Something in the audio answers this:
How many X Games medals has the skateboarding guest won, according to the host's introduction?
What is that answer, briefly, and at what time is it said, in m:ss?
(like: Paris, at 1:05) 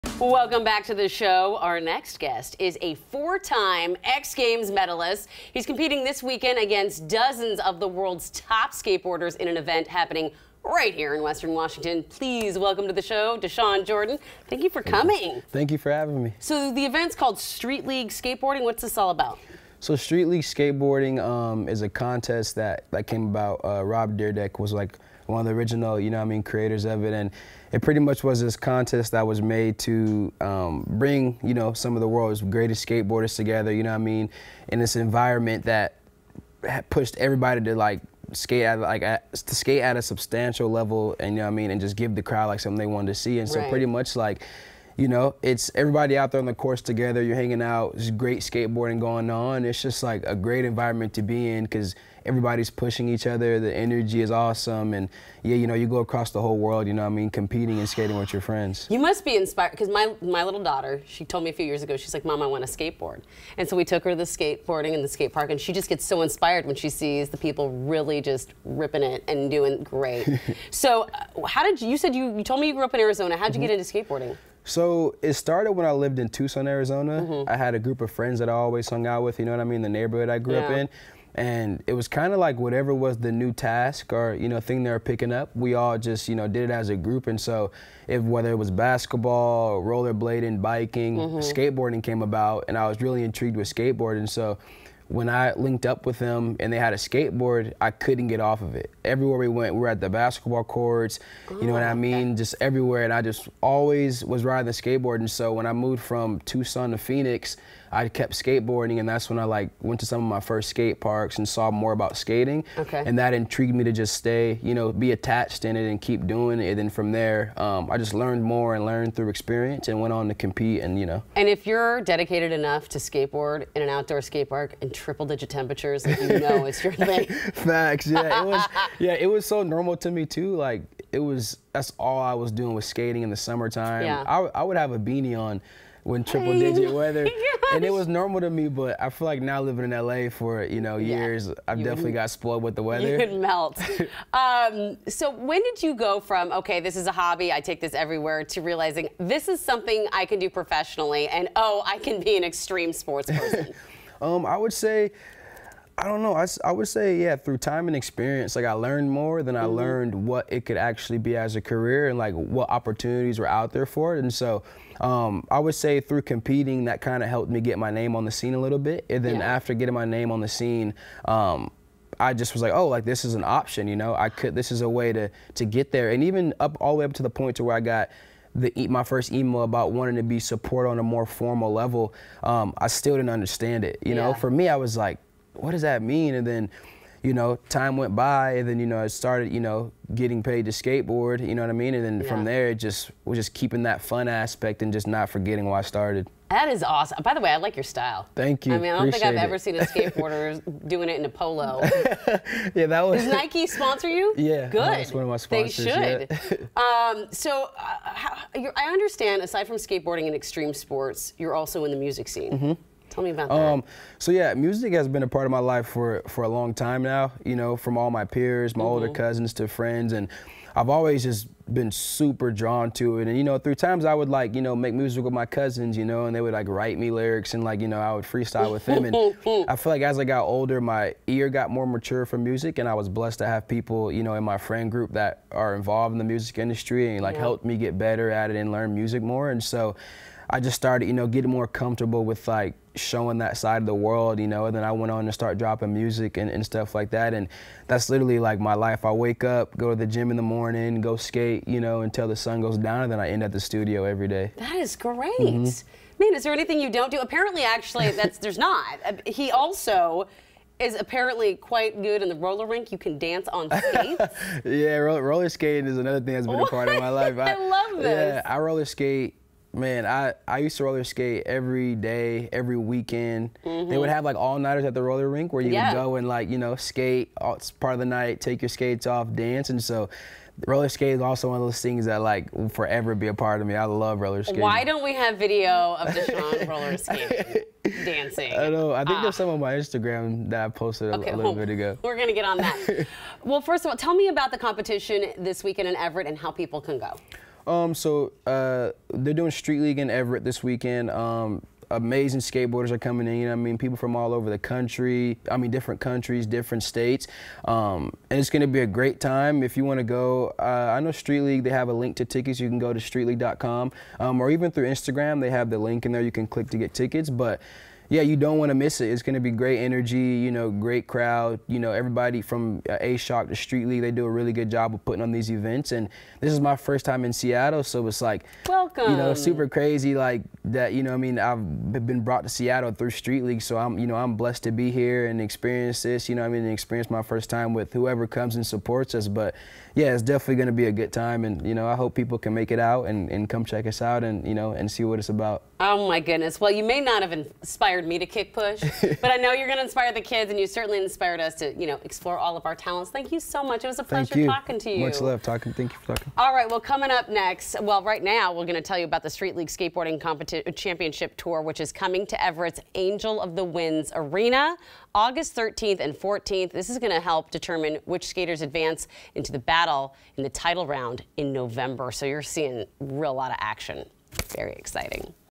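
4, at 0:02.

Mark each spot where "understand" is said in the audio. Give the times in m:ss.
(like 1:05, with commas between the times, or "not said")
3:03, 3:28.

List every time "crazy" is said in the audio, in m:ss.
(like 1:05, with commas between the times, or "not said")
5:29.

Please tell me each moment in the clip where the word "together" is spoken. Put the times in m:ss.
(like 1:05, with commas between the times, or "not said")
0:33, 0:46.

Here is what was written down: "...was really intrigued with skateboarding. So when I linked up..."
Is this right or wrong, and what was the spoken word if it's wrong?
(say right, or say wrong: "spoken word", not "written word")
right.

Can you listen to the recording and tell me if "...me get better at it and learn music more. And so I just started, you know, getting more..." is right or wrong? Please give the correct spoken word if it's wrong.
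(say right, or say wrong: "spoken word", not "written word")
right.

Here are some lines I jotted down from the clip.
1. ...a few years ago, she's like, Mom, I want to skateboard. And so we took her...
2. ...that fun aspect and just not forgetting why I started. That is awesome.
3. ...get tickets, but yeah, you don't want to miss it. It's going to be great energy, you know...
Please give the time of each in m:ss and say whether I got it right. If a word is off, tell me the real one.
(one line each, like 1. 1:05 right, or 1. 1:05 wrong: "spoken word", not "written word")
1. 1:01 right
2. 3:13 right
3. 5:16 right.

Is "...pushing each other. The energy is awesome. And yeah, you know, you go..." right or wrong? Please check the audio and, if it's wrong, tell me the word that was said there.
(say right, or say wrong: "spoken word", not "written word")
right.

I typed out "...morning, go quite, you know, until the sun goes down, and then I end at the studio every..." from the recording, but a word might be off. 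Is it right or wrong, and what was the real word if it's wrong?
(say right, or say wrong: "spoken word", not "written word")
wrong: "skate", not "quite".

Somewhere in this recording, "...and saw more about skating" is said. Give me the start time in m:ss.
1:51.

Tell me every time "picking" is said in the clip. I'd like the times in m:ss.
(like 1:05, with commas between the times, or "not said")
1:24.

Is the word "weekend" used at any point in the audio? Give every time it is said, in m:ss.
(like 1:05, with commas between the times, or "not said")
0:06, 4:32, 4:55, 5:00.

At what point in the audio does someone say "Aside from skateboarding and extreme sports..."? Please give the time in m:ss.
3:29.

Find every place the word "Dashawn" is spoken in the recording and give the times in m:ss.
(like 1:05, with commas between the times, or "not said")
0:13, 4:46.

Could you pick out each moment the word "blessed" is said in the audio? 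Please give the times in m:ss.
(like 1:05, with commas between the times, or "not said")
3:53, 5:34.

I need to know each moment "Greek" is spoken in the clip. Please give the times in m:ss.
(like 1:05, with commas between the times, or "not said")
not said.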